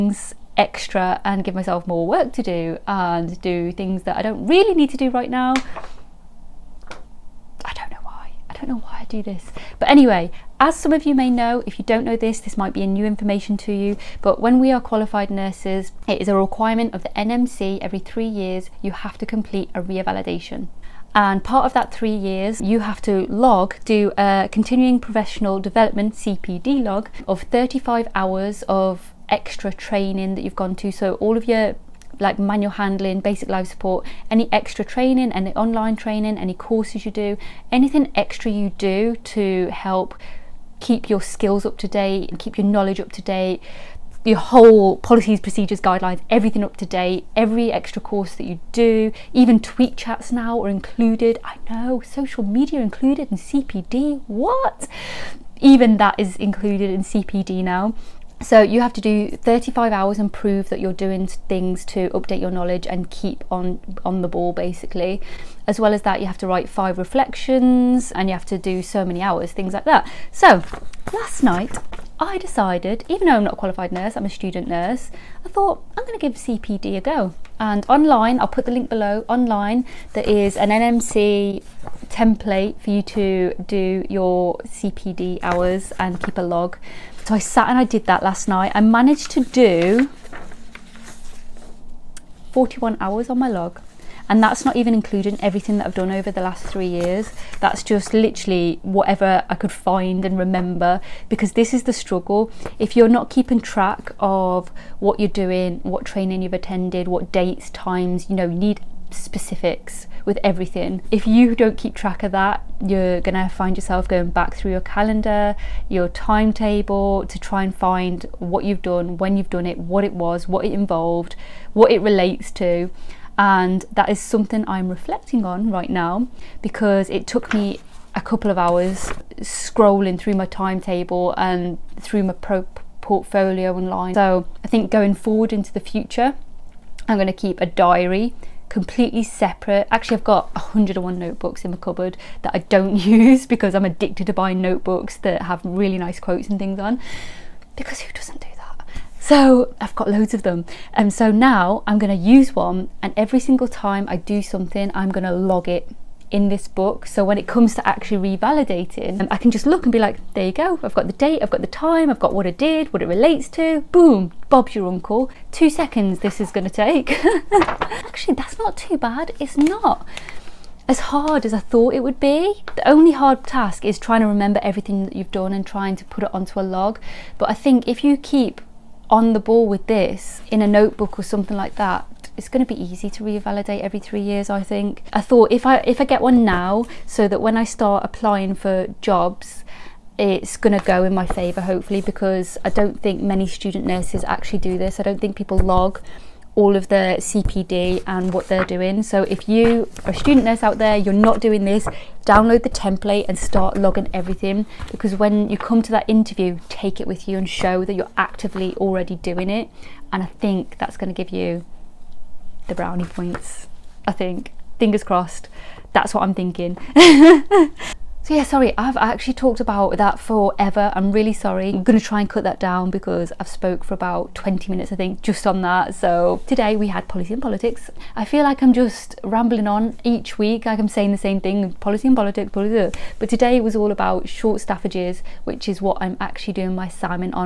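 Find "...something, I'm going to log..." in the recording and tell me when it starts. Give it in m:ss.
2:34.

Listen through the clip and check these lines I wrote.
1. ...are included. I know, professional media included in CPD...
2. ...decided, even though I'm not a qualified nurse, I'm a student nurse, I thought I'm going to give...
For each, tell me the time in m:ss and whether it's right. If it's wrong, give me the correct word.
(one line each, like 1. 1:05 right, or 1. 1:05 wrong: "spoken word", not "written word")
1. 0:50 wrong: "social", not "professional"
2. 1:12 right.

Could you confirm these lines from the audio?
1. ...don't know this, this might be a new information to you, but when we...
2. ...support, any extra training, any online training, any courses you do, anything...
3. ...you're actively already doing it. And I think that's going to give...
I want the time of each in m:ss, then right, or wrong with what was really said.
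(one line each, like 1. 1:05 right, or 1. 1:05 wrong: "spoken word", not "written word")
1. 0:11 right
2. 0:33 right
3. 3:27 right.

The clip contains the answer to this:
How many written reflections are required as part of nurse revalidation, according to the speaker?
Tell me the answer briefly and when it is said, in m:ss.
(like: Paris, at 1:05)
5, at 1:06.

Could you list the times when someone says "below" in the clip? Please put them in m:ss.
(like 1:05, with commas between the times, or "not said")
1:18.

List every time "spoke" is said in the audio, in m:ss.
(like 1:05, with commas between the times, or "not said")
3:43.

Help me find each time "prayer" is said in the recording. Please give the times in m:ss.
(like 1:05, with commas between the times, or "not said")
not said.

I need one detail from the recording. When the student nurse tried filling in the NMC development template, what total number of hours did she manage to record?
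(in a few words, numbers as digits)
41.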